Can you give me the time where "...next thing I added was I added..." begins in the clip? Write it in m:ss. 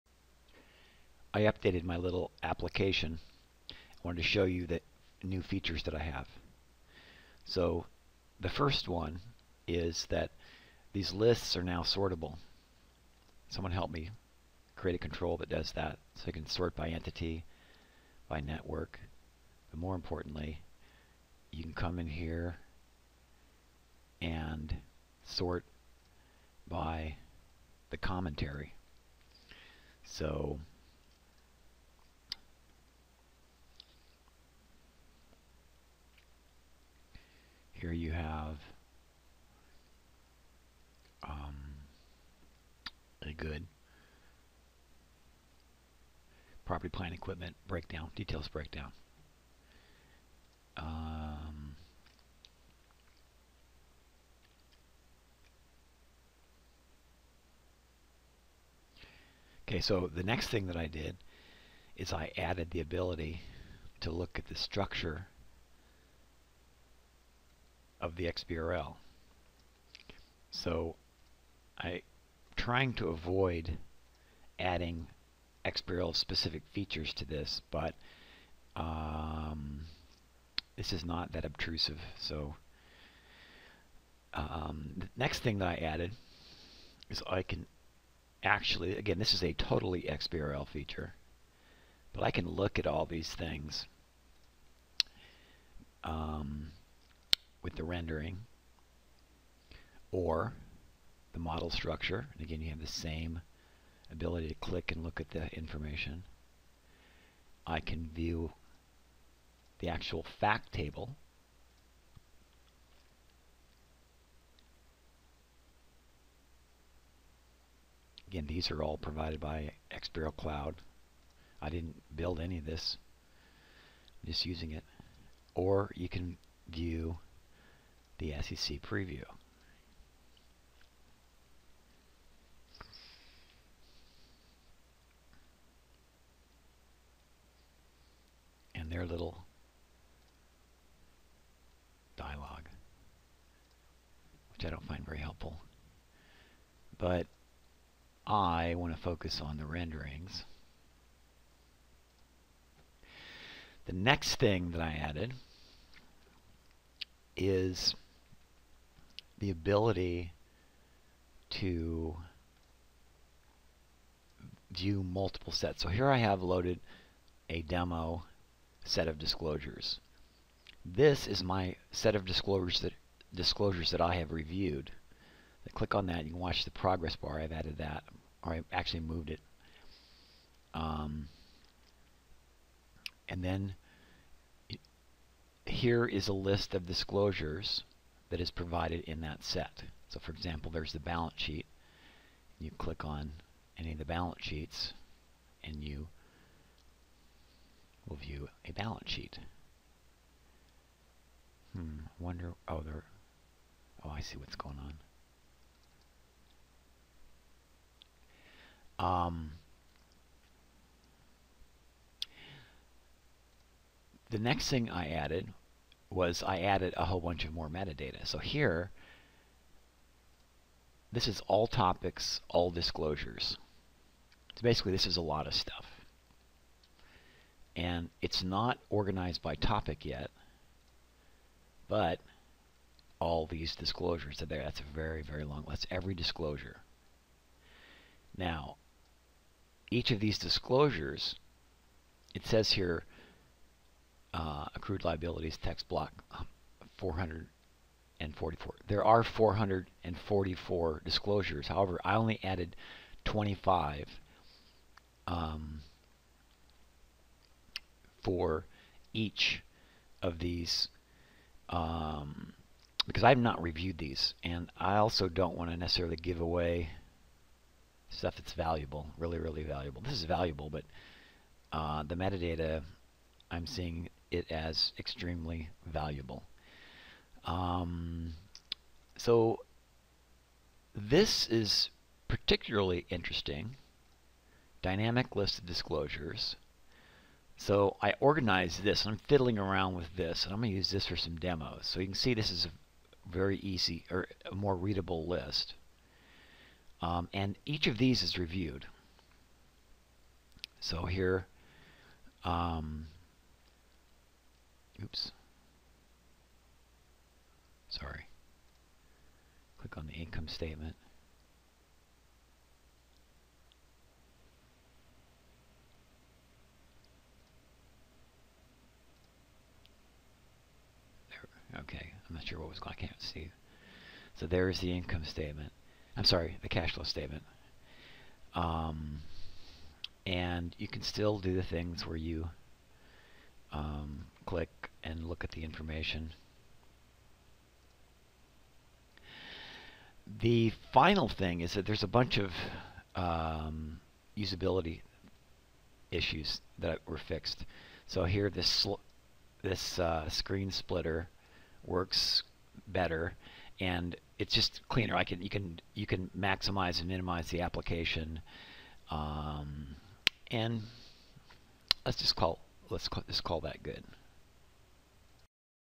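3:34.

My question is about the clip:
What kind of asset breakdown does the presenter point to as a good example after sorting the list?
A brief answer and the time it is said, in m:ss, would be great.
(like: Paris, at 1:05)
property, plant, equipment, at 0:46.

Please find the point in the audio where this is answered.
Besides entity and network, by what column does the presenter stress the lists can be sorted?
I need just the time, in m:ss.
0:27.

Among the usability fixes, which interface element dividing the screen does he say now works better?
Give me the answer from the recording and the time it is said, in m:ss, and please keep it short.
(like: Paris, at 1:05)
screen splitter, at 5:50.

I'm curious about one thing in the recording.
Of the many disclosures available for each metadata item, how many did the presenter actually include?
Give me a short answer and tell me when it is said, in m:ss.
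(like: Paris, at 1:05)
25, at 4:13.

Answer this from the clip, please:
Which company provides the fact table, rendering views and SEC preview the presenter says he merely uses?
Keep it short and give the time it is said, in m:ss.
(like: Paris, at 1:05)
XBRL Cloud, at 1:59.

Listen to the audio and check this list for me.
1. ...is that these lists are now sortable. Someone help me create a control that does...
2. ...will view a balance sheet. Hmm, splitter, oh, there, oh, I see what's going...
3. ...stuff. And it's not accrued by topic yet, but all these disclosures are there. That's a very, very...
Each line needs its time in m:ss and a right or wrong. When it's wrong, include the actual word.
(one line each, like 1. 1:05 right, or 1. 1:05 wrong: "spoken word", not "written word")
1. 0:09 right
2. 3:18 wrong: "wonder", not "splitter"
3. 3:45 wrong: "organized", not "accrued".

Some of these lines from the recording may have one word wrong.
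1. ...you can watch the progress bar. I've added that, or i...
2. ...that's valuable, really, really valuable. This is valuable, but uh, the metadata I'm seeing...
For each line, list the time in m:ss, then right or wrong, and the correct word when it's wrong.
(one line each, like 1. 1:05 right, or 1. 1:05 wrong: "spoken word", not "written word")
1. 2:56 right
2. 4:28 right.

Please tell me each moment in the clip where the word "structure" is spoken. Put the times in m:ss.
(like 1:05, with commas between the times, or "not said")
1:04, 1:41.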